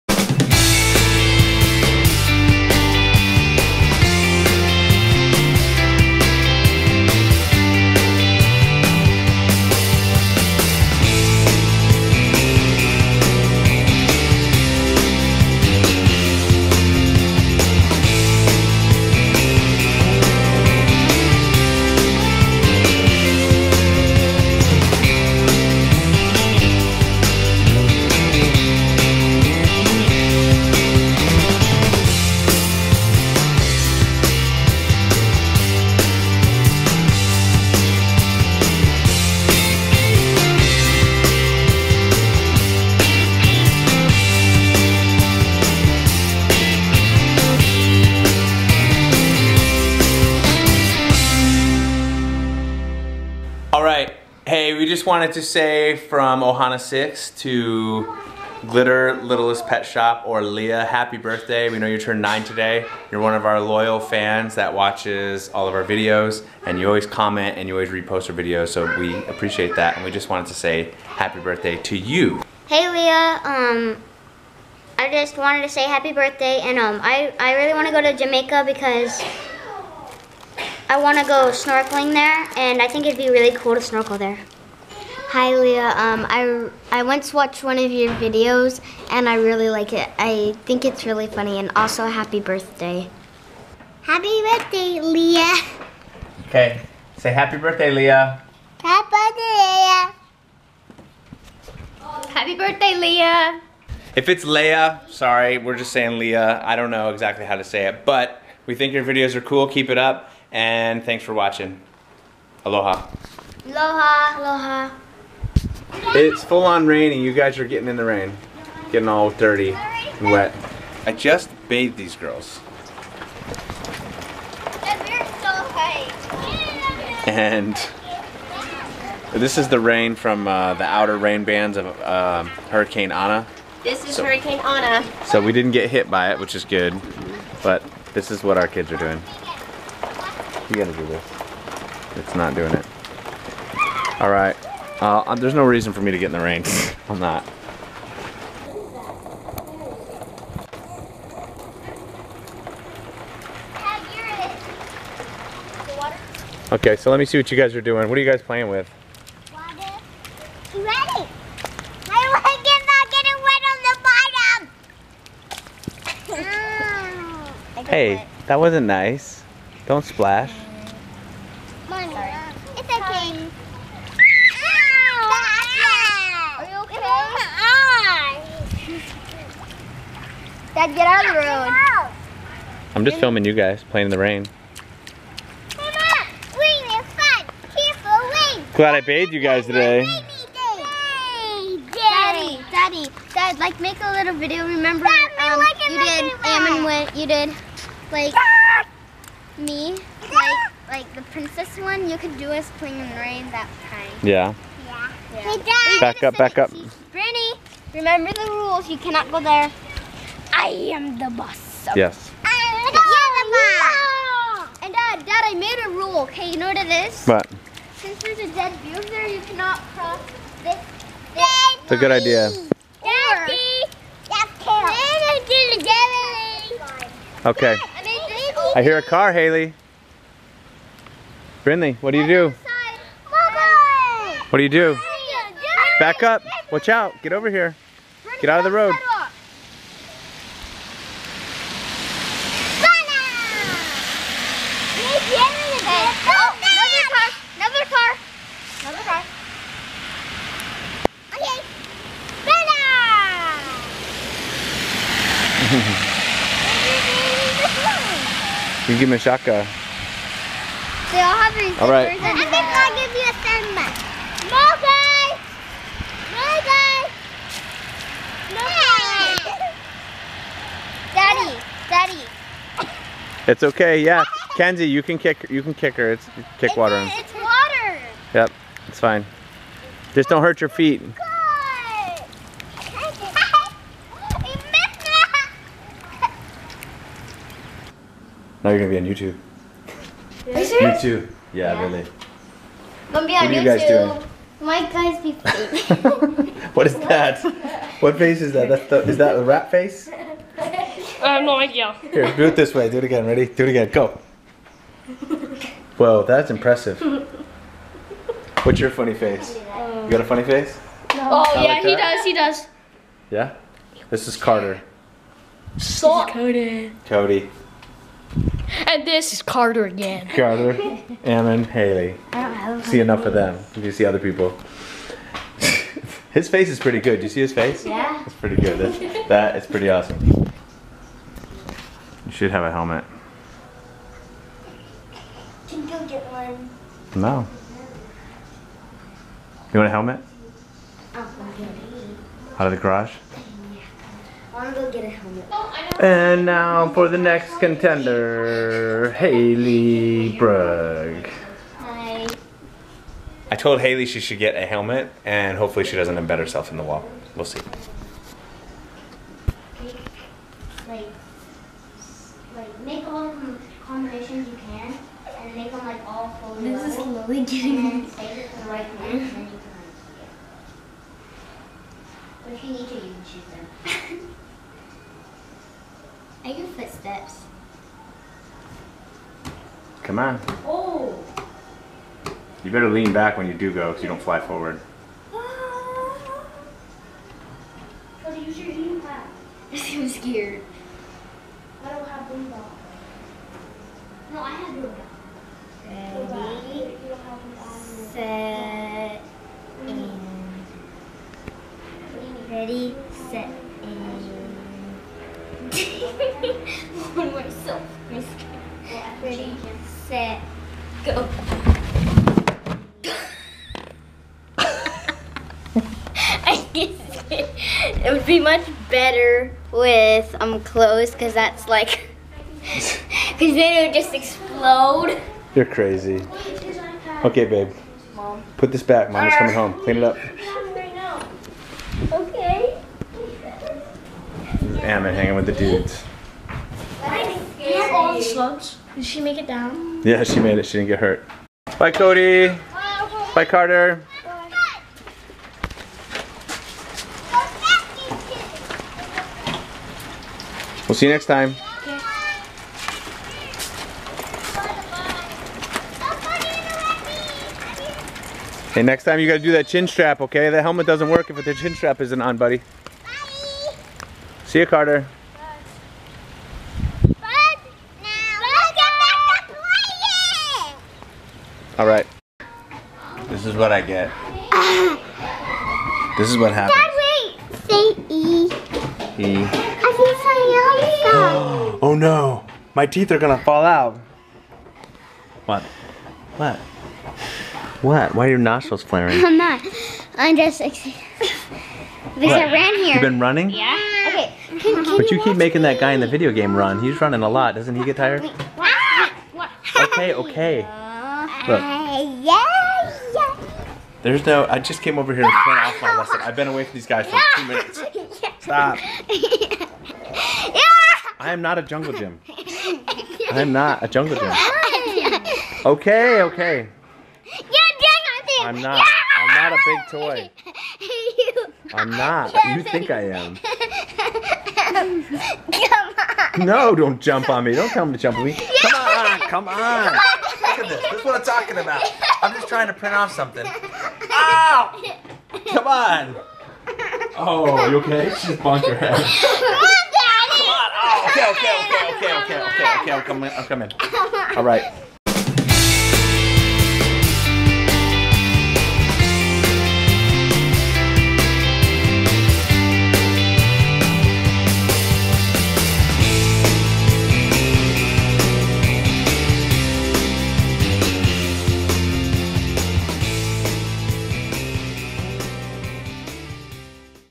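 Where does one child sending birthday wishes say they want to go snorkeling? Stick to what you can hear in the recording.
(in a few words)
Jamaica.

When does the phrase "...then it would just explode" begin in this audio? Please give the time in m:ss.
7:03.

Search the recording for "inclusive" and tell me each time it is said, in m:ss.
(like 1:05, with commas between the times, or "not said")
not said.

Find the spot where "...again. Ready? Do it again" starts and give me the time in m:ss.
5:03.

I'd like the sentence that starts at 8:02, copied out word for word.
My teeth are gonna fall out.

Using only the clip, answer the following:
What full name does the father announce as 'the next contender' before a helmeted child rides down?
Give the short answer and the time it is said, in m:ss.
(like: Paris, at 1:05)
Haley Brug, at 5:49.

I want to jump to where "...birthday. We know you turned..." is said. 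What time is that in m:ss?
1:01.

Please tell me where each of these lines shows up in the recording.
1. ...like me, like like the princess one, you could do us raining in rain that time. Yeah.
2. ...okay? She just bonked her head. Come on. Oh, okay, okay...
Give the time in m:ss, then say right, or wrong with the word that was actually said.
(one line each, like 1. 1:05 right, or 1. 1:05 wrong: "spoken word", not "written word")
1. 3:18 wrong: "playing", not "raining"
2. 8:57 right.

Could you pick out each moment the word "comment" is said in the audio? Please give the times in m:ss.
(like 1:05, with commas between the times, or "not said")
1:07.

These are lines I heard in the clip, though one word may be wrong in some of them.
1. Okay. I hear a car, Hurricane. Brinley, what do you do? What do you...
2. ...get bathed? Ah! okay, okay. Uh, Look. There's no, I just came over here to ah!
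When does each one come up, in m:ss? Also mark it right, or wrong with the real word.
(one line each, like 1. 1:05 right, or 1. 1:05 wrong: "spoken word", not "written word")
1. 3:47 wrong: "Haley", not "Hurricane"
2. 8:17 wrong: "tired", not "bathed".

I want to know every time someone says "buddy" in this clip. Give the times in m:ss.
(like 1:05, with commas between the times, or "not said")
7:42.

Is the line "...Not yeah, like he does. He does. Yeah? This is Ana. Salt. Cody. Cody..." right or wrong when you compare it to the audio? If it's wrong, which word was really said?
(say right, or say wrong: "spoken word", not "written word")
wrong: "Carter", not "Ana".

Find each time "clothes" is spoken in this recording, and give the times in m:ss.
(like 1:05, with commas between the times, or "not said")
7:00.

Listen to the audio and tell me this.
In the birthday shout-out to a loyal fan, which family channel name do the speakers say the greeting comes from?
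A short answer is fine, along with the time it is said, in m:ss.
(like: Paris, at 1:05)
Ohana 6, at 0:56.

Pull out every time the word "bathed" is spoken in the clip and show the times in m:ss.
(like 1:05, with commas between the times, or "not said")
2:01, 3:09.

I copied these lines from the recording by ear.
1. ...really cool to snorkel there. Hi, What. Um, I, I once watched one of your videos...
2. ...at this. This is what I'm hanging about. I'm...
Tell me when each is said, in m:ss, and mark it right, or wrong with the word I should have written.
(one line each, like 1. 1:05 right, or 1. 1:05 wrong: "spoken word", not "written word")
1. 1:23 wrong: "Leah", not "What"
2. 8:50 wrong: "talking", not "hanging".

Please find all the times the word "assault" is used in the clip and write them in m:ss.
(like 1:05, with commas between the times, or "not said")
not said.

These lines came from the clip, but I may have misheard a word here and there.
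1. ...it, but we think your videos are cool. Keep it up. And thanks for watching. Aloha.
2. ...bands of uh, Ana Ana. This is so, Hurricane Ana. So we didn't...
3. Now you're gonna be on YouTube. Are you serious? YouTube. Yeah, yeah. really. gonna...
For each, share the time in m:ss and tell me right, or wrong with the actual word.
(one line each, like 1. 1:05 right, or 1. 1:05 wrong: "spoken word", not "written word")
1. 1:47 right
2. 2:11 wrong: "Hurricane", not "Ana"
3. 4:48 right.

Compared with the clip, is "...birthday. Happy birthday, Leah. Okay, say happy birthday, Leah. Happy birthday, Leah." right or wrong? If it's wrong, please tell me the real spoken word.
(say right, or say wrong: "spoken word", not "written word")
right.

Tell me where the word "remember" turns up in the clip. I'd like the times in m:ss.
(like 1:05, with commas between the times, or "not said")
3:14, 3:27.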